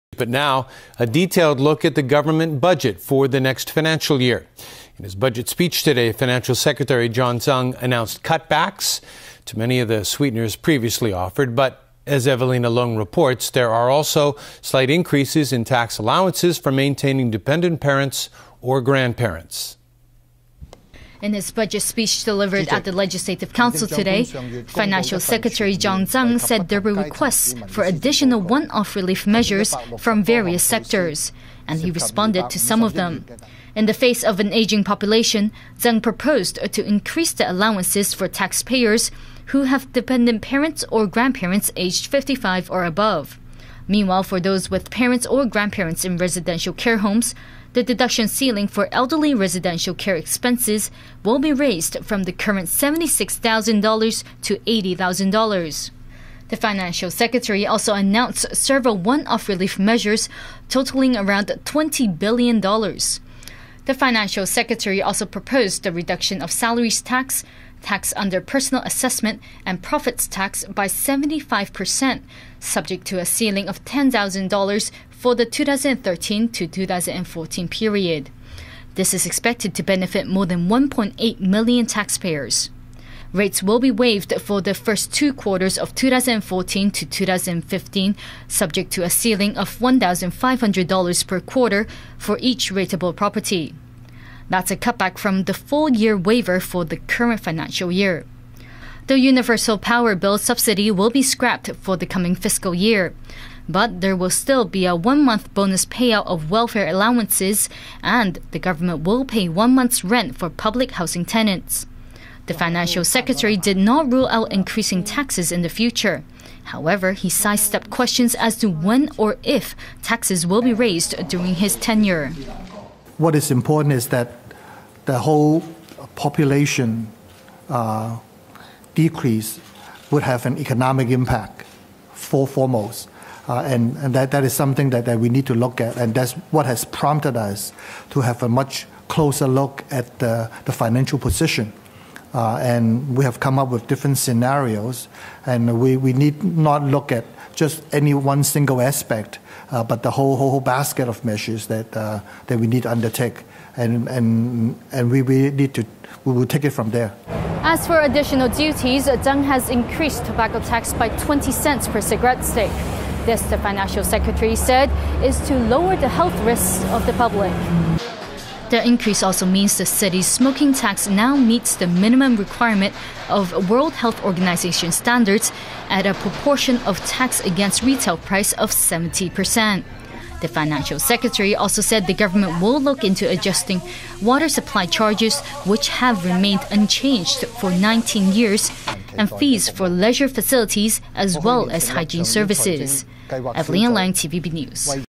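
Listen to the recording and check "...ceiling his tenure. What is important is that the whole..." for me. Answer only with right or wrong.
wrong.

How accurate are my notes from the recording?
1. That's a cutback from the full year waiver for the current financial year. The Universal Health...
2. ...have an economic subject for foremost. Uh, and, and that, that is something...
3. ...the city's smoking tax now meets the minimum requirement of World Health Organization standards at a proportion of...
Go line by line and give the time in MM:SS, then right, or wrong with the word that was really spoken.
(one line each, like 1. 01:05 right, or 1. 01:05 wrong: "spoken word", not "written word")
1. 01:34 wrong: "Power", not "Health"
2. 02:10 wrong: "impact", not "subject"
3. 02:49 right.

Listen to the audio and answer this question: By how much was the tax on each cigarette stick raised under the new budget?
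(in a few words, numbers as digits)
20 cents.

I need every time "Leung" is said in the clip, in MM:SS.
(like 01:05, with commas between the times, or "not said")
00:12, 03:13.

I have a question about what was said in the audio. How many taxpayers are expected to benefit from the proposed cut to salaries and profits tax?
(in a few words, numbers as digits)
more than 1.8 million.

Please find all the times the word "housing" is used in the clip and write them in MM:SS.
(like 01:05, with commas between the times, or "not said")
01:50.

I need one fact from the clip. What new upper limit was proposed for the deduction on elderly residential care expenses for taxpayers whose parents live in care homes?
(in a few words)
$80,000.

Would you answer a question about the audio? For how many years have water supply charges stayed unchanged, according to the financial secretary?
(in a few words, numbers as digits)
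19 years.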